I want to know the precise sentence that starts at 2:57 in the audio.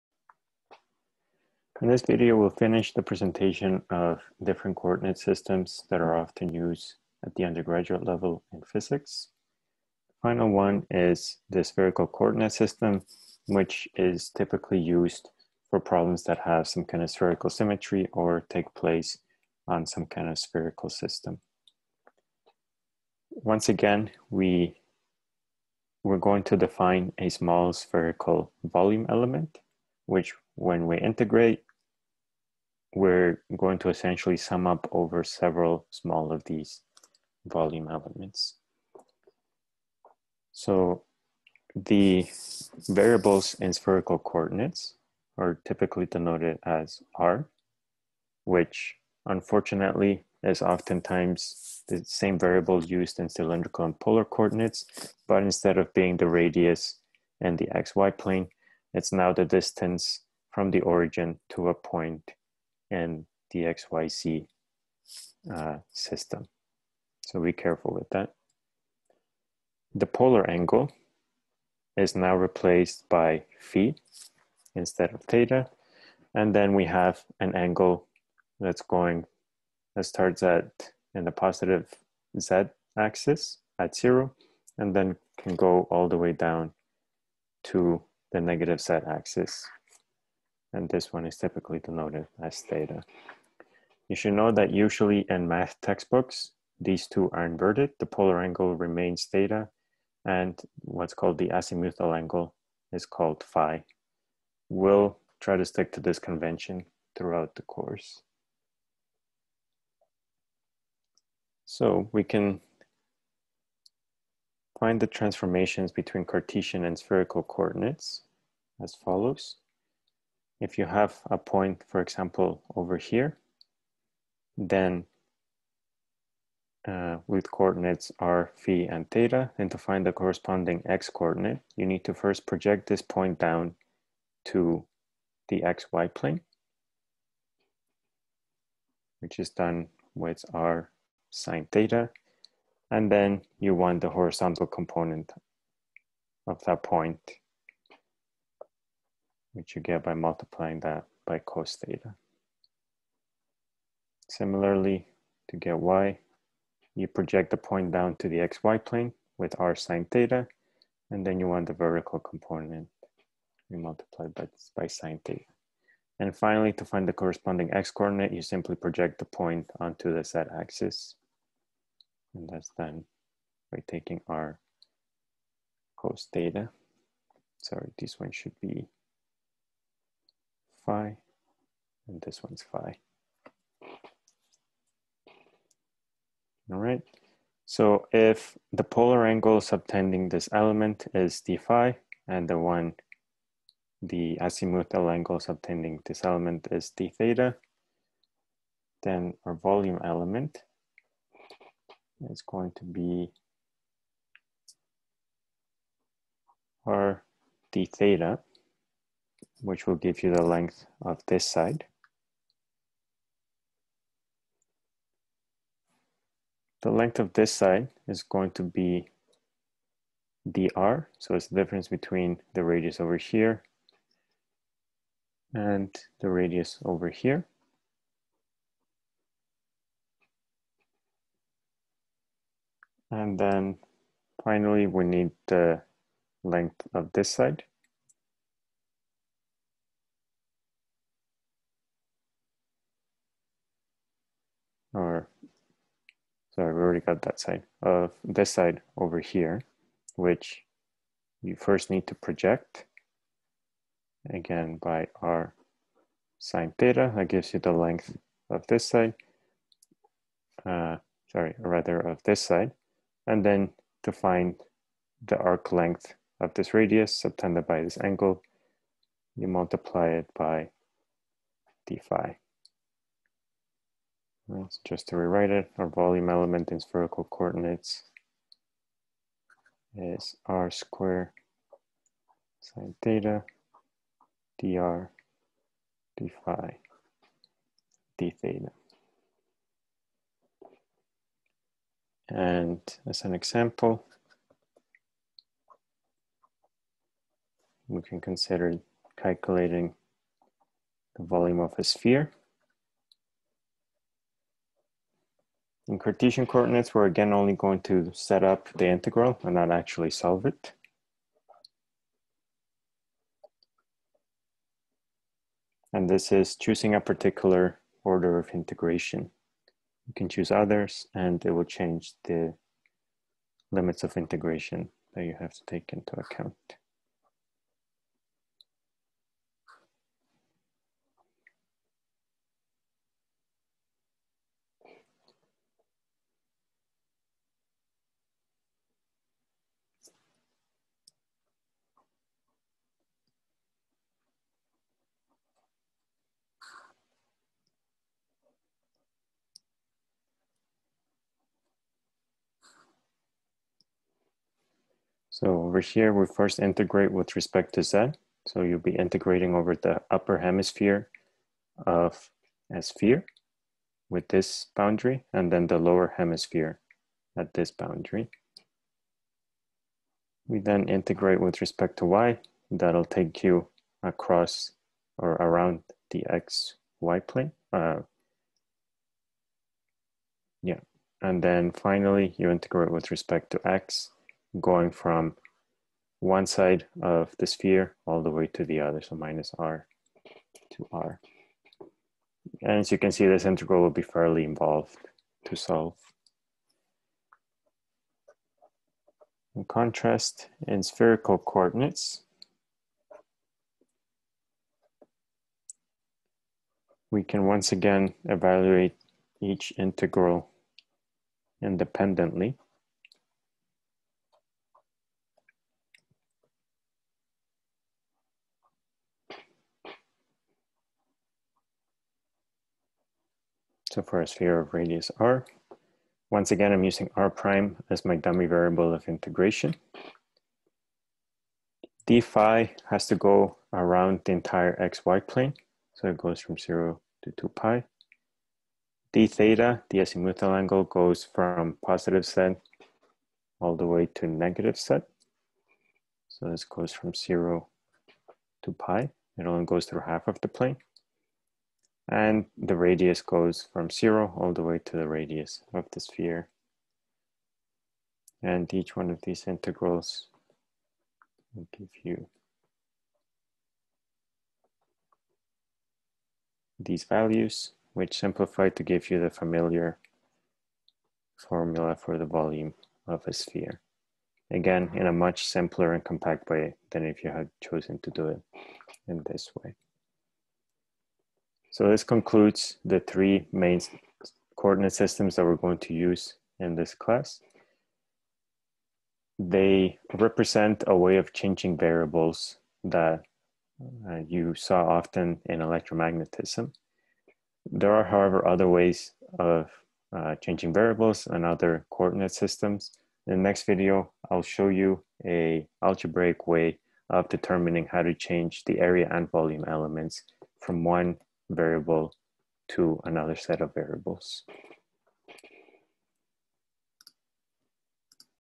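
Sorry, this one should be phi, and this one's phi.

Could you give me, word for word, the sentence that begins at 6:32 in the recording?
And as you can see, this integral will be fairly involved to solve.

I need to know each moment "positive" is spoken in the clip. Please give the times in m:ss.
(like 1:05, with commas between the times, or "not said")
1:21, 7:21.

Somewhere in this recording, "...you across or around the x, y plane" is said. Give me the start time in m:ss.
6:13.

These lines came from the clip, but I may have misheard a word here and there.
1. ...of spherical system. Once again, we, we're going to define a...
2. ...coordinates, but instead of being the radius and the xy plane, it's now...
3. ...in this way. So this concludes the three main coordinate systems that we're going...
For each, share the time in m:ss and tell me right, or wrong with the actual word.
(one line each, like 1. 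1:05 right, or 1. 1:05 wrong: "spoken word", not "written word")
1. 0:20 right
2. 0:54 right
3. 7:59 right.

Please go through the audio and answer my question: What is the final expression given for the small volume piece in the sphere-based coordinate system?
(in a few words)
r^2 sin theta dr dphi dtheta.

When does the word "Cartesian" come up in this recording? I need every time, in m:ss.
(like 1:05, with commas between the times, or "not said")
1:56, 5:05.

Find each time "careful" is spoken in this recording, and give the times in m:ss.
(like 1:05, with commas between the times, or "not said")
1:07.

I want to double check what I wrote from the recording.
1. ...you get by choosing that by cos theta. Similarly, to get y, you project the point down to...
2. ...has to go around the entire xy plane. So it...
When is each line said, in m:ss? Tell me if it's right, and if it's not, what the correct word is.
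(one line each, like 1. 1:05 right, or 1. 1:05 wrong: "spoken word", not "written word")
1. 2:29 wrong: "multiplying", not "choosing"
2. 7:12 right.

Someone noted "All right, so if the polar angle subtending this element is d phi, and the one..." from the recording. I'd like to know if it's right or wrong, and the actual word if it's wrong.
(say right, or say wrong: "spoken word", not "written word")
right.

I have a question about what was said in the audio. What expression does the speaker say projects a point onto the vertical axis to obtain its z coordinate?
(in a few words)
r cos theta.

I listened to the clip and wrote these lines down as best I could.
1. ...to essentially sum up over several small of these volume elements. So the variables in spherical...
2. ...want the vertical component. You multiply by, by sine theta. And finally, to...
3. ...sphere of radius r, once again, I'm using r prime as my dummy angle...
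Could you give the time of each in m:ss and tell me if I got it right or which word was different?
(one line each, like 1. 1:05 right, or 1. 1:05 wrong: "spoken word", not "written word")
1. 0:33 right
2. 2:41 right
3. 7:04 wrong: "variable", not "angle".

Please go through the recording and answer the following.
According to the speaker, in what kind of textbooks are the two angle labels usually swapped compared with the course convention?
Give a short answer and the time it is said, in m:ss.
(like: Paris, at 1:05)
math textbooks, at 1:35.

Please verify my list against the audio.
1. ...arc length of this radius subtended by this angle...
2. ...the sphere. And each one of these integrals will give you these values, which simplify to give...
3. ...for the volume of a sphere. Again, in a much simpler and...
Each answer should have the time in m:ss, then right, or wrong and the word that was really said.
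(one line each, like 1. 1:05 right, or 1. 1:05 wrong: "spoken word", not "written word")
1. 4:25 right
2. 7:35 right
3. 7:51 right.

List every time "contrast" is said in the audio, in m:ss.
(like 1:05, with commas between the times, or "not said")
6:39.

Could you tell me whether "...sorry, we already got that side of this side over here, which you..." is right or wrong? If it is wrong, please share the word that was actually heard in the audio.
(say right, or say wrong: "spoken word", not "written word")
right.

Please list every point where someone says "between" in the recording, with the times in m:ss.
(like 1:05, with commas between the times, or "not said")
1:55, 3:41.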